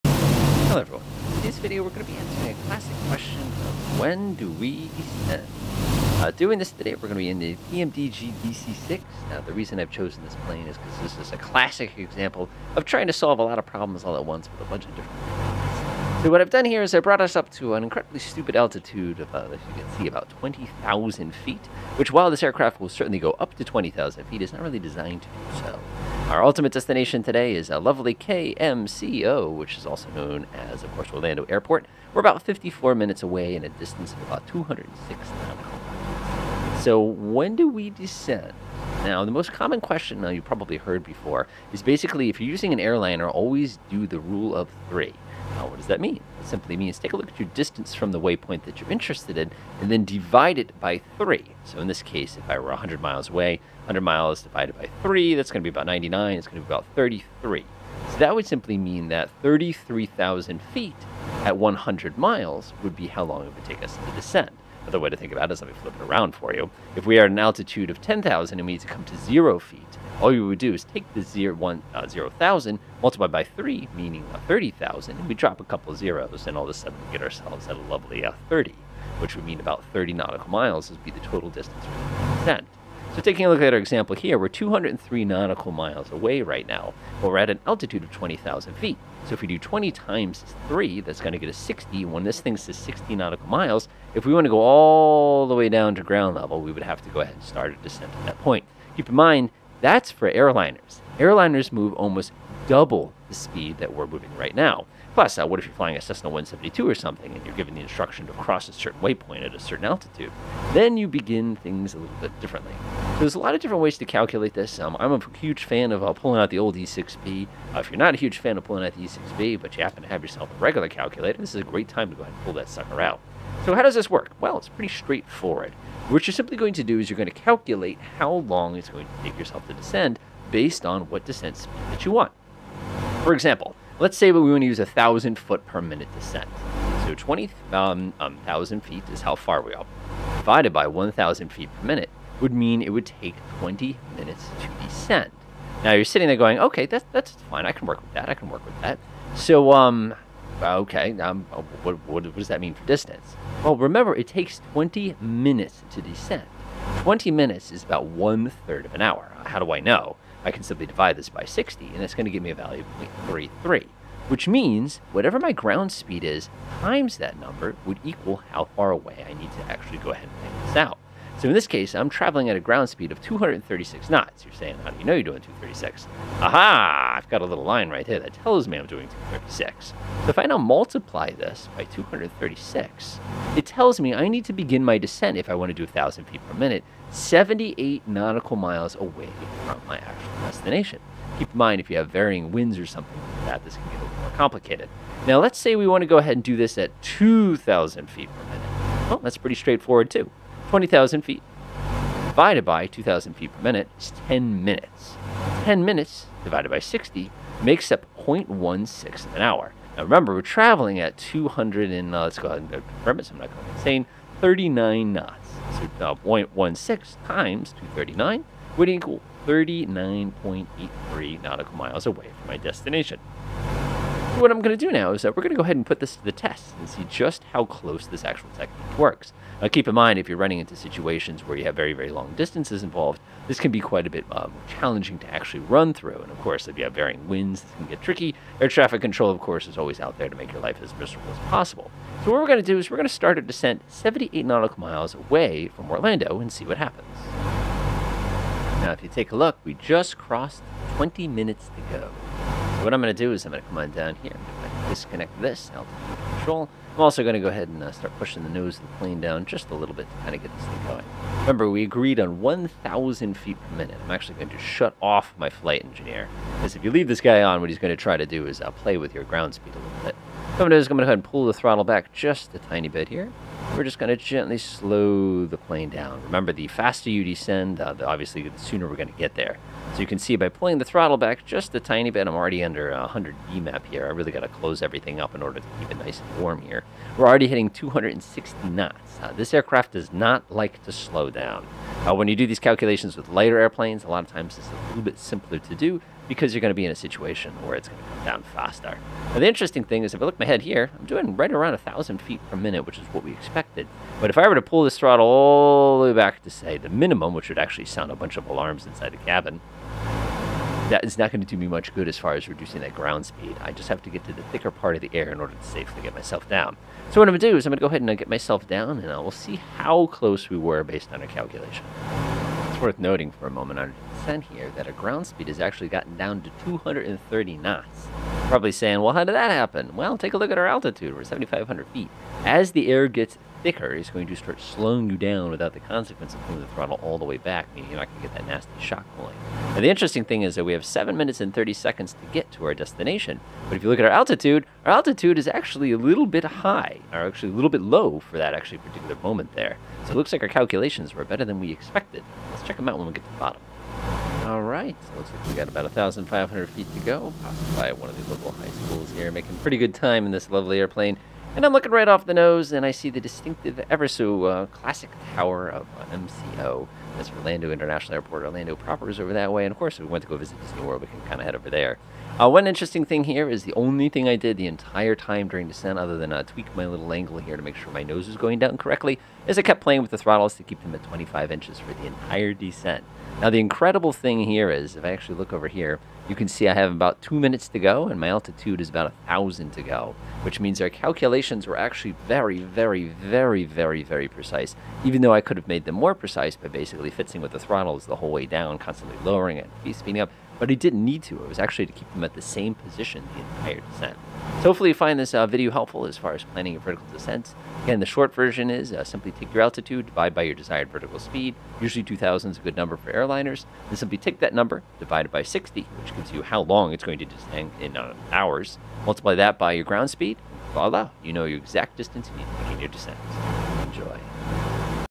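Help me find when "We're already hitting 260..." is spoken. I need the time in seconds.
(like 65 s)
287 s.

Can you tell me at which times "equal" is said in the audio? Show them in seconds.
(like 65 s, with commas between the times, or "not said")
168 s, 218 s.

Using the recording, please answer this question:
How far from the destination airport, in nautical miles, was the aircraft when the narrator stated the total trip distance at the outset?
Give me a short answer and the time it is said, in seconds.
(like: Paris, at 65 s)
206, at 34 s.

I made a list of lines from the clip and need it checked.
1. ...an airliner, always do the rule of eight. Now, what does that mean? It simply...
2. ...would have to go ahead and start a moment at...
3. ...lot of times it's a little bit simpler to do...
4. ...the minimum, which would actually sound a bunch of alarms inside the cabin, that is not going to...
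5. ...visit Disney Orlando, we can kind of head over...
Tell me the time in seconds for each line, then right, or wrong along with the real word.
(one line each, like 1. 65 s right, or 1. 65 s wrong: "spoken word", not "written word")
1. 42 s wrong: "three", not "eight"
2. 96 s wrong: "descent", not "moment"
3. 294 s right
4. 306 s right
5. 370 s wrong: "World", not "Orlando".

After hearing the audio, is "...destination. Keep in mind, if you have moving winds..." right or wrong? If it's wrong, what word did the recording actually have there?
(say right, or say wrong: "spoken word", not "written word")
wrong: "varying", not "moving".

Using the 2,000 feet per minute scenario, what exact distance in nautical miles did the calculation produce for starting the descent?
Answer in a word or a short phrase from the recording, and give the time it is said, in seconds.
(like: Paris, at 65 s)
39.83, at 219 s.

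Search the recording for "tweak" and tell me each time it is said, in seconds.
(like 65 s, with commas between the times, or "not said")
376 s.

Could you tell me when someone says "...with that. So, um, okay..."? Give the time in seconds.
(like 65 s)
148 s.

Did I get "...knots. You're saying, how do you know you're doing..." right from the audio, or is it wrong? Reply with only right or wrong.
right.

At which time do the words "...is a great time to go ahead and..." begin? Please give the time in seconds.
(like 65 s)
121 s.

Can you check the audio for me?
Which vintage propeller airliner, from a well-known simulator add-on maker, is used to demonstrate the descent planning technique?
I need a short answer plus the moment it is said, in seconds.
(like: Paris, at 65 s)
PMDG DC-6, at 7 s.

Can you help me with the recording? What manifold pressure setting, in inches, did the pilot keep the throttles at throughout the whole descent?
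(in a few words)
25 inches.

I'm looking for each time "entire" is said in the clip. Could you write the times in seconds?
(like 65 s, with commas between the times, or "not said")
374 s, 382 s, 403 s.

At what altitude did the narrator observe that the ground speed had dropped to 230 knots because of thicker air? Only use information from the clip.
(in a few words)
7,500 feet.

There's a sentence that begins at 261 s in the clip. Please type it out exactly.
Remember, we agreed on 1,000 feet per minute.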